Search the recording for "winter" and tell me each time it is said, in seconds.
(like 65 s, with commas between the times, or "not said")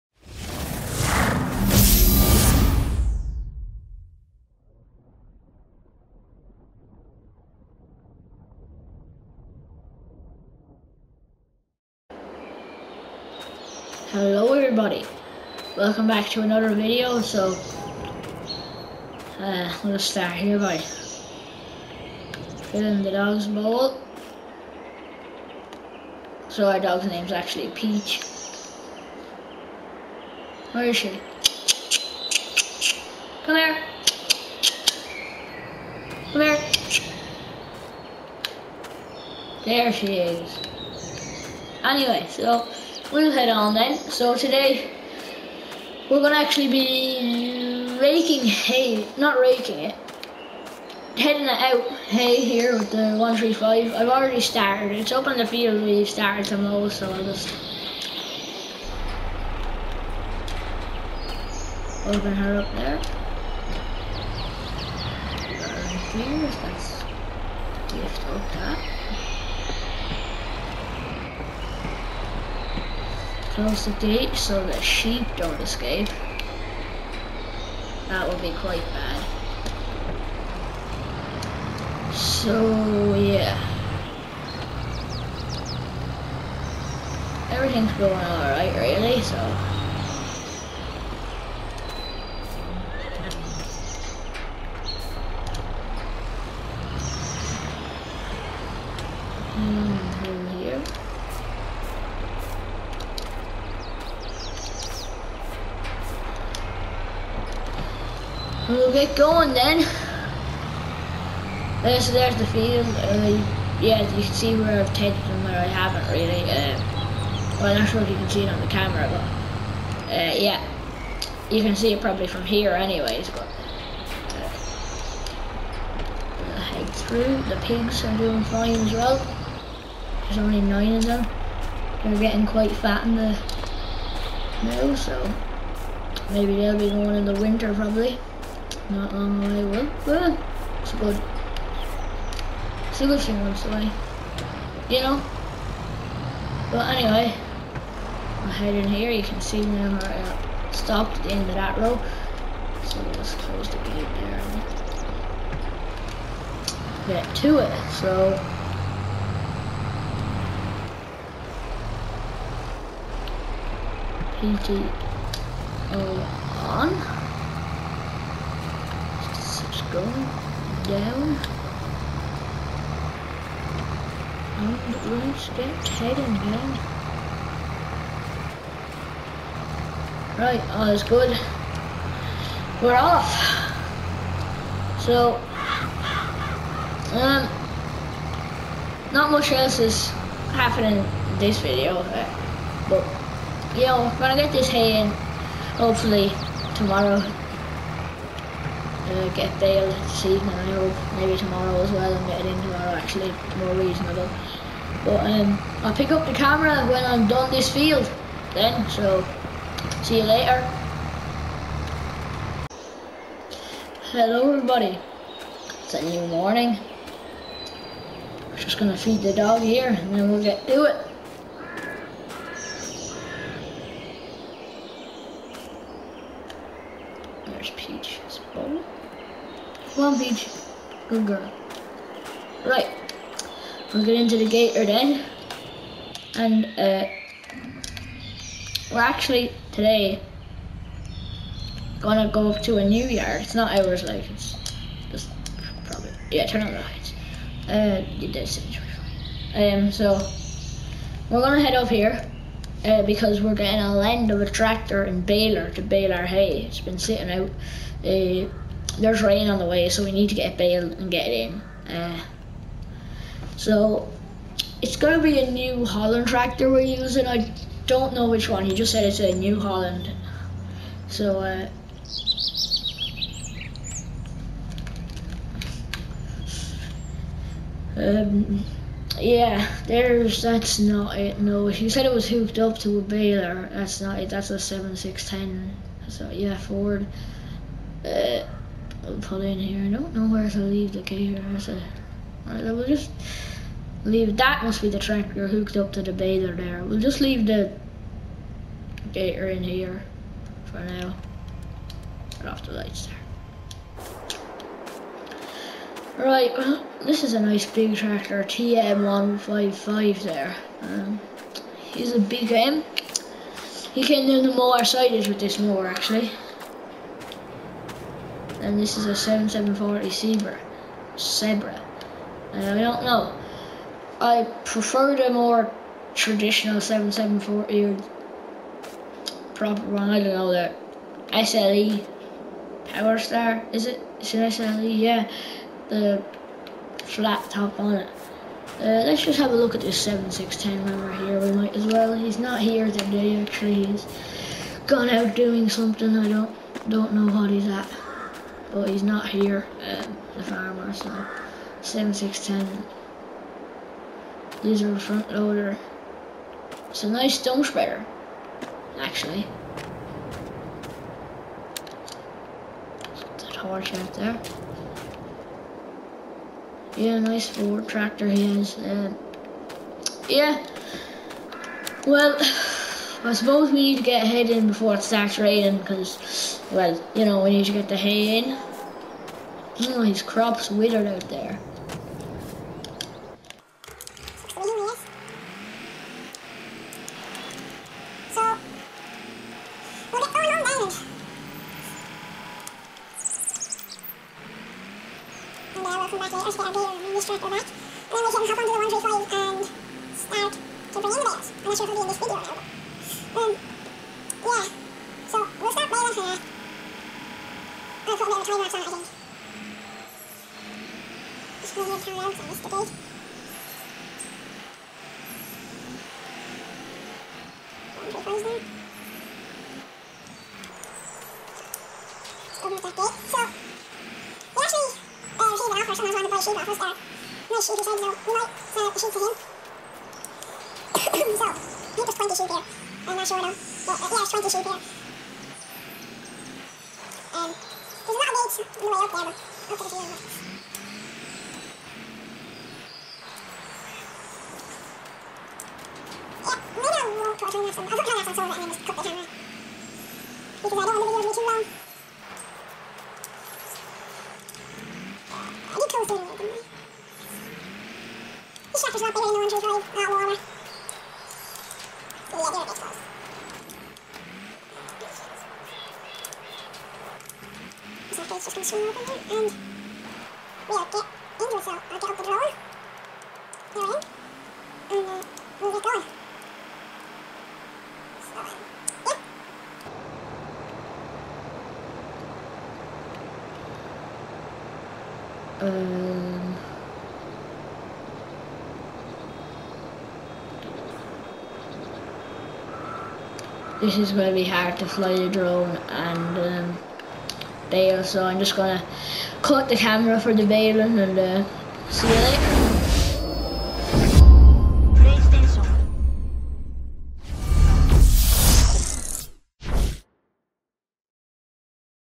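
137 s.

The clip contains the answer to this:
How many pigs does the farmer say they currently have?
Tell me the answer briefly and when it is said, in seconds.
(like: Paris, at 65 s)
9, at 130 s.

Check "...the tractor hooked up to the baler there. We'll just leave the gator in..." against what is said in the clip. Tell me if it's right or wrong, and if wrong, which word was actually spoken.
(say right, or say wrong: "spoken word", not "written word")
right.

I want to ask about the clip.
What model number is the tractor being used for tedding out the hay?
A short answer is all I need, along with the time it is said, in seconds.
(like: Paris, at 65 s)
135, at 53 s.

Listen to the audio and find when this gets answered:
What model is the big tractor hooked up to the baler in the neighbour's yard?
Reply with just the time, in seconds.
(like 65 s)
308 s.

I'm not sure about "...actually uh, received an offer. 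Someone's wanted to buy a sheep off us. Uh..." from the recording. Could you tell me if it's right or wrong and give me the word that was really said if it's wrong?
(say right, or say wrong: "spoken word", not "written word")
right.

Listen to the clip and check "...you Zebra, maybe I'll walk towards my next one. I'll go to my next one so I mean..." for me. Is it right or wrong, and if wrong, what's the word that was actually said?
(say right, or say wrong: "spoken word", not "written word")
wrong: "Yeah", not "Zebra".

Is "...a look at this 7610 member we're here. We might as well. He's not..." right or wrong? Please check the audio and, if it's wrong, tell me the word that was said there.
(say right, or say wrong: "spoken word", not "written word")
right.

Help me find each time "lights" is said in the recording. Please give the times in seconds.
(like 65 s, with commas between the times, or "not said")
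246 s, 302 s.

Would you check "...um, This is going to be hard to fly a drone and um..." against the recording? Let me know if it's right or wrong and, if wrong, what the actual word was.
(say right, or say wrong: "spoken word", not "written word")
right.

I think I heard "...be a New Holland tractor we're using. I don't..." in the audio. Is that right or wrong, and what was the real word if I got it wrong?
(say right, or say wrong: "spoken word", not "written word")
right.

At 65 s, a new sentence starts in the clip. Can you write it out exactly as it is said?
Right here, that's lift up that.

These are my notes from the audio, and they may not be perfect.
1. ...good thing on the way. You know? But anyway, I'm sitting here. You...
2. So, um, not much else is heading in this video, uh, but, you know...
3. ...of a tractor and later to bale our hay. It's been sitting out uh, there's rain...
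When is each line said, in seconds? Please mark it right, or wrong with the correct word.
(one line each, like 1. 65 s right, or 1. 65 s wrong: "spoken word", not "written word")
1. 143 s wrong: "heading", not "sitting"
2. 185 s wrong: "happening", not "heading"
3. 254 s wrong: "baler", not "later".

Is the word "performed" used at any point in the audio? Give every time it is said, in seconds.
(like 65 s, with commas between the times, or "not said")
not said.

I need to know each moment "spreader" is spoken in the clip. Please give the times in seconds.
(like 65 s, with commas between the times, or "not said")
357 s.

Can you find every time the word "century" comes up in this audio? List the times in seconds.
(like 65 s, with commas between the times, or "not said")
not said.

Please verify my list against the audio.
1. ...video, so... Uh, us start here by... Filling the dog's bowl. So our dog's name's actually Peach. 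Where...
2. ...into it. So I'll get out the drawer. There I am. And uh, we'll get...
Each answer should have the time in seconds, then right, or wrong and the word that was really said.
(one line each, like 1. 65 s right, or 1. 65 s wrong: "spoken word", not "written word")
1. 16 s right
2. 469 s right.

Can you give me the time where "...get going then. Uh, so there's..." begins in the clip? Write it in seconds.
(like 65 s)
108 s.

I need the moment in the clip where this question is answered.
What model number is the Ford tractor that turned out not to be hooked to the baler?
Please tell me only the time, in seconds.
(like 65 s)
284 s.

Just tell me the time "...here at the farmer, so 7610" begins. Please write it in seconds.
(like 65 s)
349 s.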